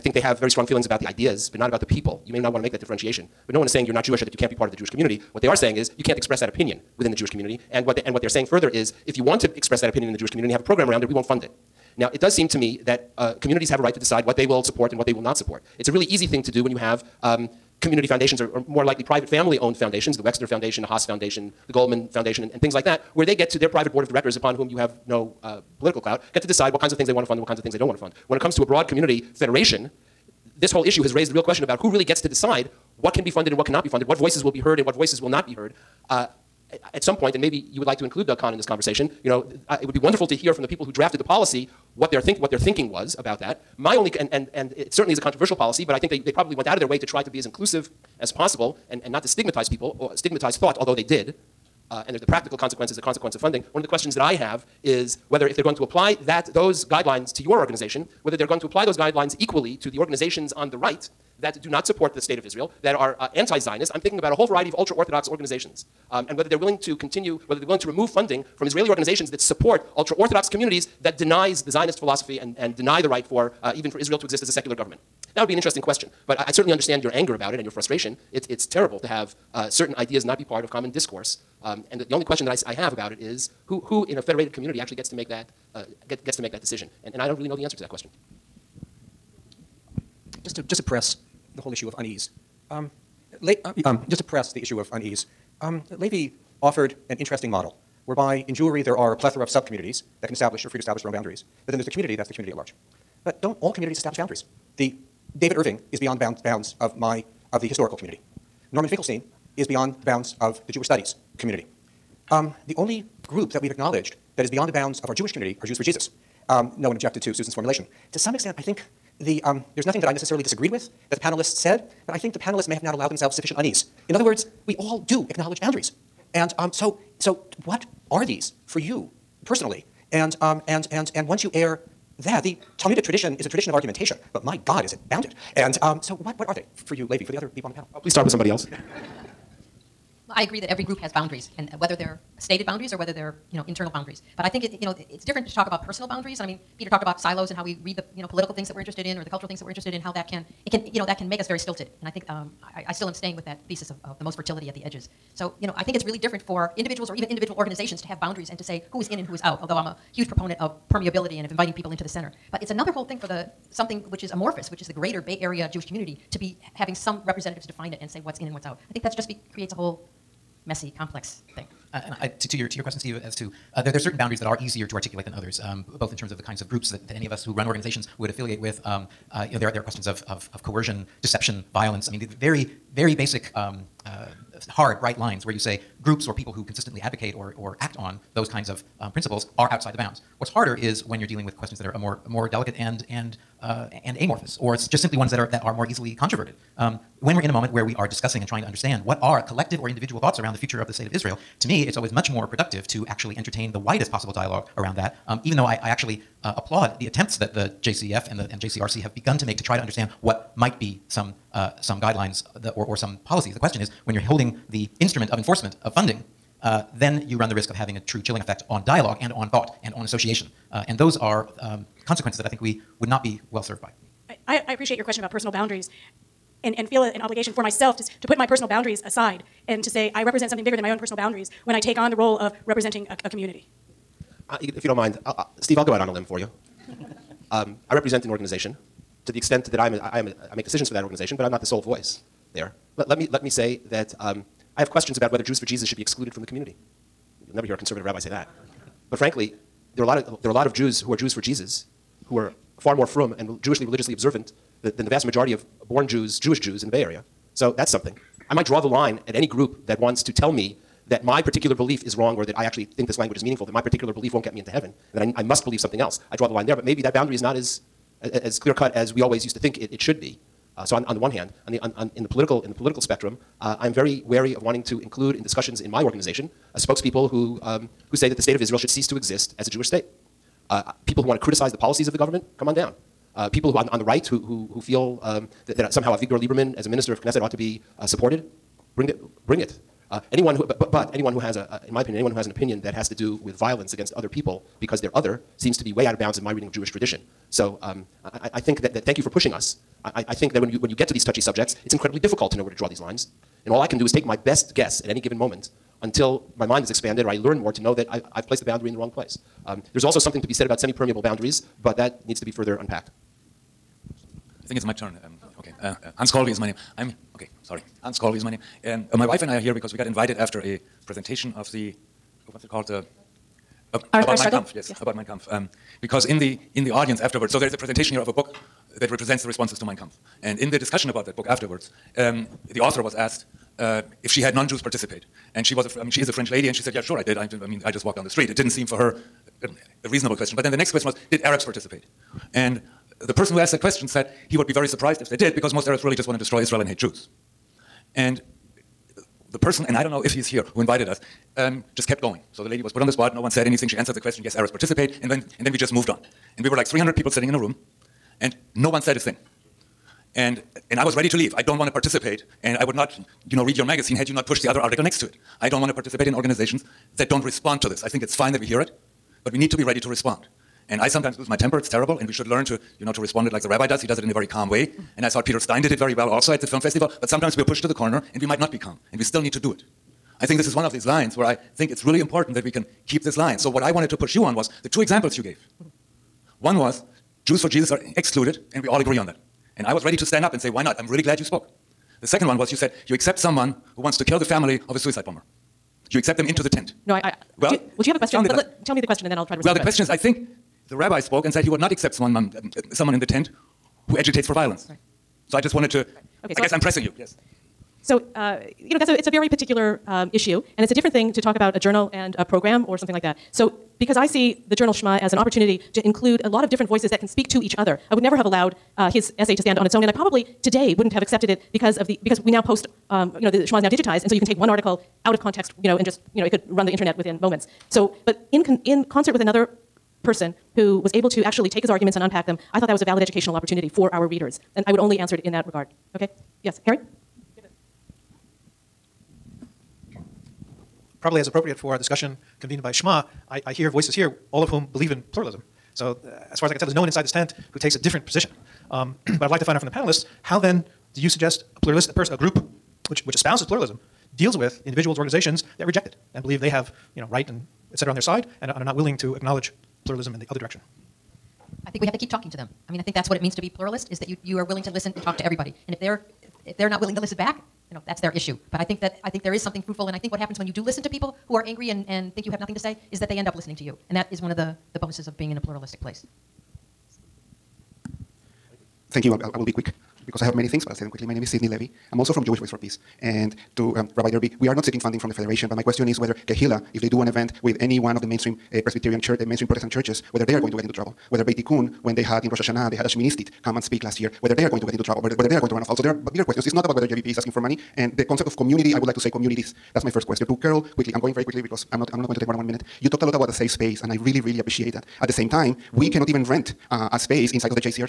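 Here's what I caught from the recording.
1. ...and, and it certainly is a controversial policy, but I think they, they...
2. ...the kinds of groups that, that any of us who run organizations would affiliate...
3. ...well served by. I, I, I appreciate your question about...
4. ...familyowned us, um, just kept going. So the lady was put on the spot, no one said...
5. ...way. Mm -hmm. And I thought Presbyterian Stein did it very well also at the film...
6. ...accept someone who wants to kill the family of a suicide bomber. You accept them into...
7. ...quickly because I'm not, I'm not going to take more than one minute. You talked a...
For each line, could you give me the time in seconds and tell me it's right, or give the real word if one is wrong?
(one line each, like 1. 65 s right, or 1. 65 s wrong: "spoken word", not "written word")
1. 44 s right
2. 176 s right
3. 223 s right
4. 350 s wrong: "invited", not "familyowned"
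5. 374 s wrong: "Peter", not "Presbyterian"
6. 393 s right
7. 501 s right.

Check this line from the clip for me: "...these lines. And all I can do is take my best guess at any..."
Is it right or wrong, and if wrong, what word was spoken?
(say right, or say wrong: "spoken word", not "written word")
right.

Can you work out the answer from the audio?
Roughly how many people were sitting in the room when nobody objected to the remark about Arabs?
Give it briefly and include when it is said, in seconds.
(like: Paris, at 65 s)
300, at 356 s.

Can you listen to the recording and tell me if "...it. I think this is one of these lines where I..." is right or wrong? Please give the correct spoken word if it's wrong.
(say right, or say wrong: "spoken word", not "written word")
right.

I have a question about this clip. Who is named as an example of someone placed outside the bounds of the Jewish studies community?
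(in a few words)
Norman Finkelstein.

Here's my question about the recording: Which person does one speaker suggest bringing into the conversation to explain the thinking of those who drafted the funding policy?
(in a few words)
Doug Kahn.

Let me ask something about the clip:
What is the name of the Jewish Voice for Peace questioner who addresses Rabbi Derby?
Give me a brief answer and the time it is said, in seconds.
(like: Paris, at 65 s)
Sidney Levy, at 481 s.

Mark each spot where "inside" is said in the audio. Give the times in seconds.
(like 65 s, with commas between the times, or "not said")
447 s, 507 s.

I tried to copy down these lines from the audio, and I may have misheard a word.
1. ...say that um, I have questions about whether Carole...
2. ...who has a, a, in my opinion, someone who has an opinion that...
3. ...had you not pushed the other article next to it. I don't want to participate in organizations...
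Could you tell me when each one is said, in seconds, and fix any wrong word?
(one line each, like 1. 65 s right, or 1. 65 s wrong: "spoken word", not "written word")
1. 243 s wrong: "Jews", not "Carole"
2. 291 s wrong: "anyone", not "someone"
3. 364 s right.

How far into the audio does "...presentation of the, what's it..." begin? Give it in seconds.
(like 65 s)
321 s.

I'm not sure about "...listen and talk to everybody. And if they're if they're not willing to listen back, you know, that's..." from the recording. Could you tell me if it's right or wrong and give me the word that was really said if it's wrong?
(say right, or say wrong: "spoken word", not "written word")
right.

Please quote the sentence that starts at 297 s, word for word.
So um, I, I, think that, that, thank you for pushing us.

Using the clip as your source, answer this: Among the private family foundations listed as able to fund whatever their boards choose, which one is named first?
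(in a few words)
Wexner Foundation.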